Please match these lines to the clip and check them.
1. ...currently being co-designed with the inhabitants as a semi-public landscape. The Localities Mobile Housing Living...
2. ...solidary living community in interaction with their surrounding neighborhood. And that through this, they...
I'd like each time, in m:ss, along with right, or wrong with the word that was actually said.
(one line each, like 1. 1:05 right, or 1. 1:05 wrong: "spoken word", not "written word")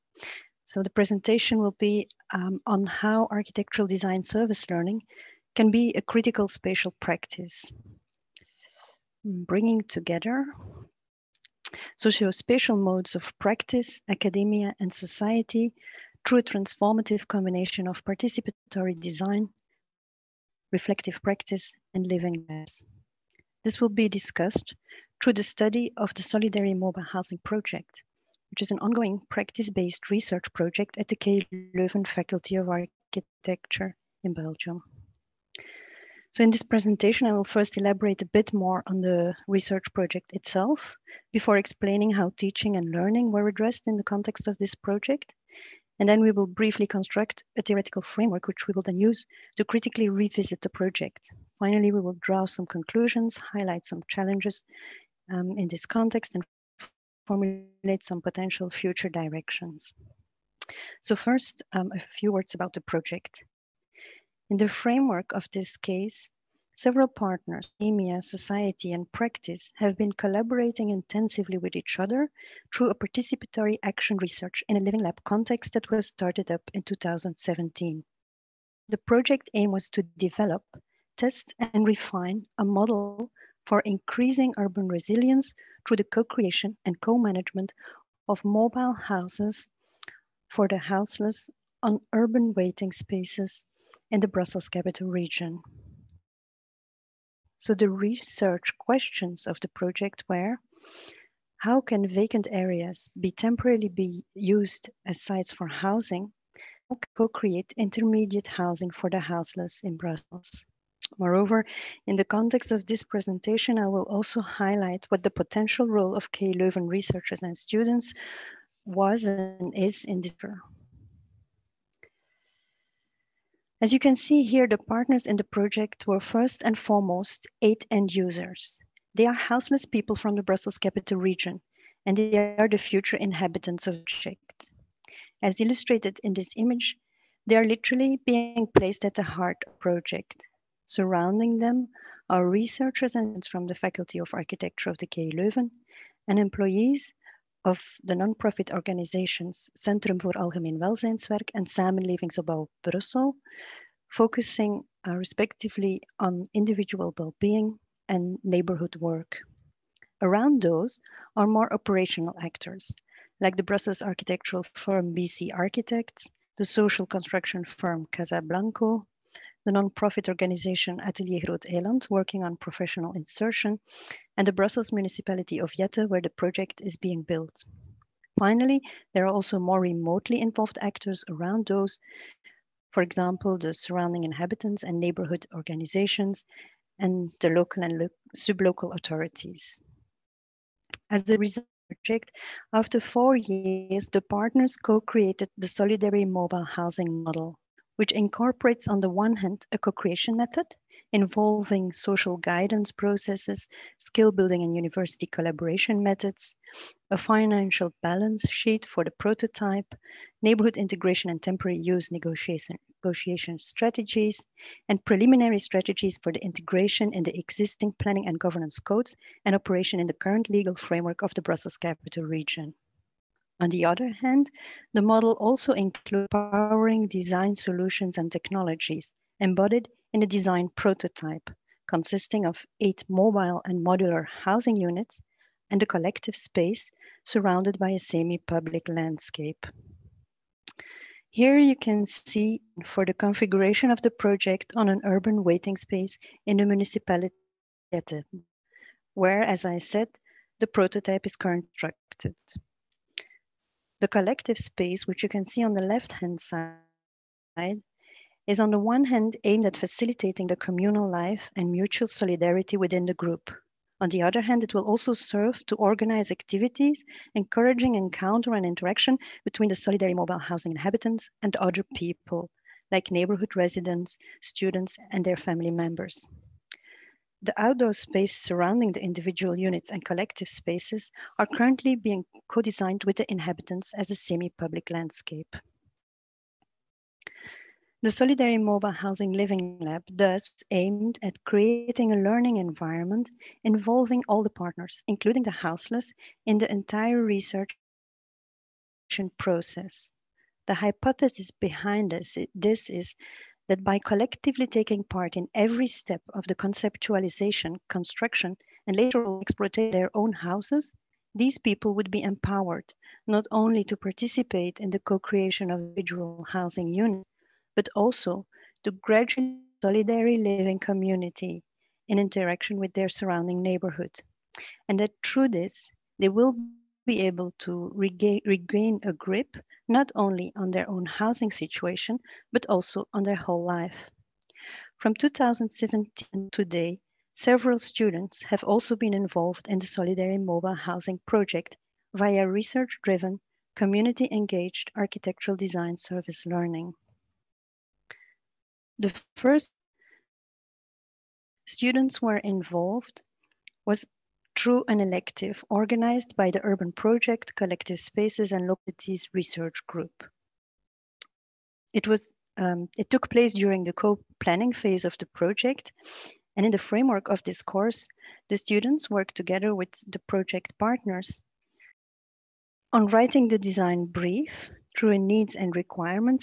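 1. 4:41 wrong: "Solidary", not "Localities"
2. 5:19 right.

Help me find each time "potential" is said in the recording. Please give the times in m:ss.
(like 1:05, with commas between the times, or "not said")
0:58, 1:55.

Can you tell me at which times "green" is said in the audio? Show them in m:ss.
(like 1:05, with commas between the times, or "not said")
not said.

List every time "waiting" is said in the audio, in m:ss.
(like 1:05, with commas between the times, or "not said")
1:32, 4:05.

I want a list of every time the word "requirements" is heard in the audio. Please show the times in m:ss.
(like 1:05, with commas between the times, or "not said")
6:15.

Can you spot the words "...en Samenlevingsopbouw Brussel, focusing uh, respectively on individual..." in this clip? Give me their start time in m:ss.
2:31.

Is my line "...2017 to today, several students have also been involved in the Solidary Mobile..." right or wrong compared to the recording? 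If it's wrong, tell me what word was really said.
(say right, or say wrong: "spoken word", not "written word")
right.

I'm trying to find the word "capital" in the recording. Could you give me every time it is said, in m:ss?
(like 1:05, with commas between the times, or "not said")
1:34, 2:10, 3:41.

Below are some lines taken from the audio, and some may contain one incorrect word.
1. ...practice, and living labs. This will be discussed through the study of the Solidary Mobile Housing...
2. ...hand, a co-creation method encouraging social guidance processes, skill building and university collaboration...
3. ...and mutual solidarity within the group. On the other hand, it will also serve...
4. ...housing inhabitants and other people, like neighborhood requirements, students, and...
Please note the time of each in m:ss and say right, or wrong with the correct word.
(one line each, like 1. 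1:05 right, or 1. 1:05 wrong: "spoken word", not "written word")
1. 0:21 right
2. 3:19 wrong: "involving", not "encouraging"
3. 4:21 right
4. 4:30 wrong: "residents", not "requirements".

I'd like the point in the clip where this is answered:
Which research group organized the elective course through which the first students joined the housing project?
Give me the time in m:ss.
5:56.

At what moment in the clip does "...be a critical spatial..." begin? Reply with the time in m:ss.
0:05.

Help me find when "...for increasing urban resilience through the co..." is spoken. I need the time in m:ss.
1:23.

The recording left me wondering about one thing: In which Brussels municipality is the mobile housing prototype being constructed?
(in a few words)
Jette.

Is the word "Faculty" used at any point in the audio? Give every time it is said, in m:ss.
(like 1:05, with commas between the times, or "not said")
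0:32, 2:23.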